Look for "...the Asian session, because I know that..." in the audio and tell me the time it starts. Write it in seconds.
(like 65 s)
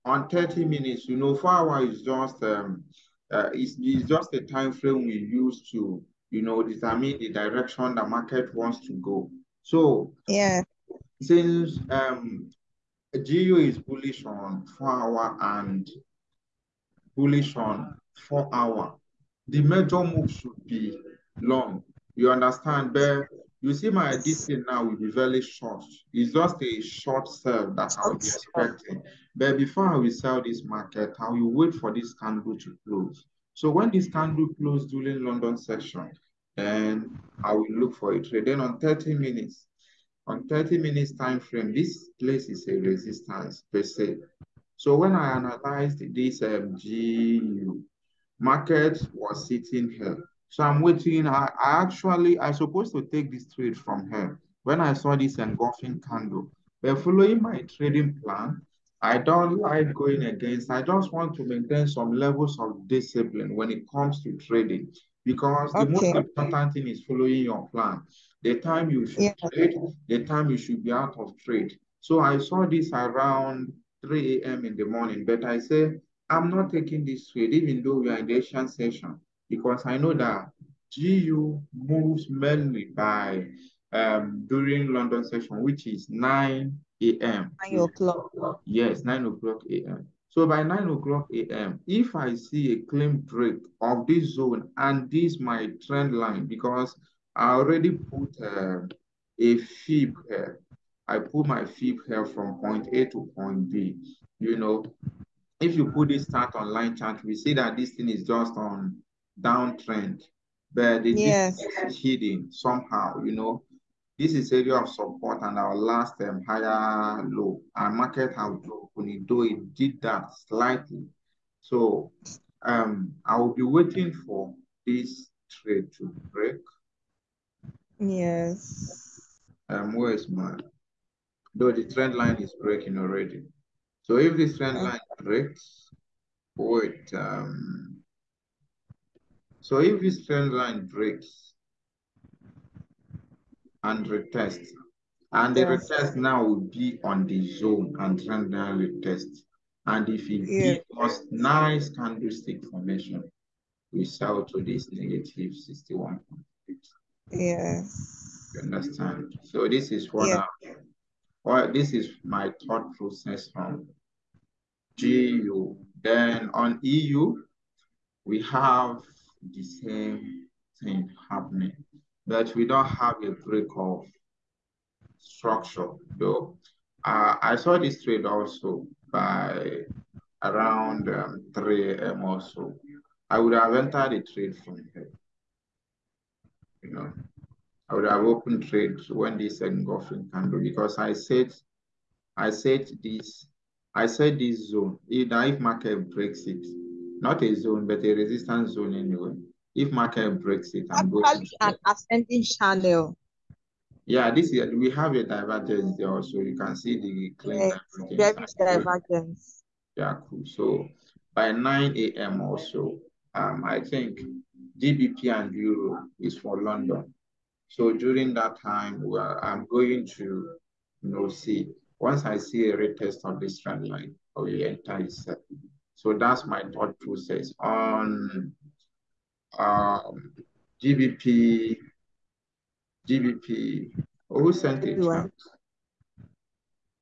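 78 s.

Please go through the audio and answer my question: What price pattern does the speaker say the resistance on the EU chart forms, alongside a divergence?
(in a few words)
Ascending channel.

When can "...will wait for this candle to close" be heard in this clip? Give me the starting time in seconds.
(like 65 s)
31 s.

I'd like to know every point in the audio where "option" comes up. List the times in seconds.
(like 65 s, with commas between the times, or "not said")
not said.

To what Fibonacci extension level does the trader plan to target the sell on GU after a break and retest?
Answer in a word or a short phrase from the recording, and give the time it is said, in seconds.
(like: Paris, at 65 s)
-61.8, at 154 s.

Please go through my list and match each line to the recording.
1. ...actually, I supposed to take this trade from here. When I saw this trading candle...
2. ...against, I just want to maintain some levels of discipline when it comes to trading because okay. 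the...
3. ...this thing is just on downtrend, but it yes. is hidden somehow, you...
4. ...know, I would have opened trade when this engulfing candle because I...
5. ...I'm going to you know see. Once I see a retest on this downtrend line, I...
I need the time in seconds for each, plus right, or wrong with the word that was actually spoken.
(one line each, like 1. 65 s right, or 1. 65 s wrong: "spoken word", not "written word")
1. 51 s wrong: "engulfing", not "trading"
2. 60 s right
3. 107 s right
4. 186 s right
5. 219 s wrong: "trend", not "downtrend".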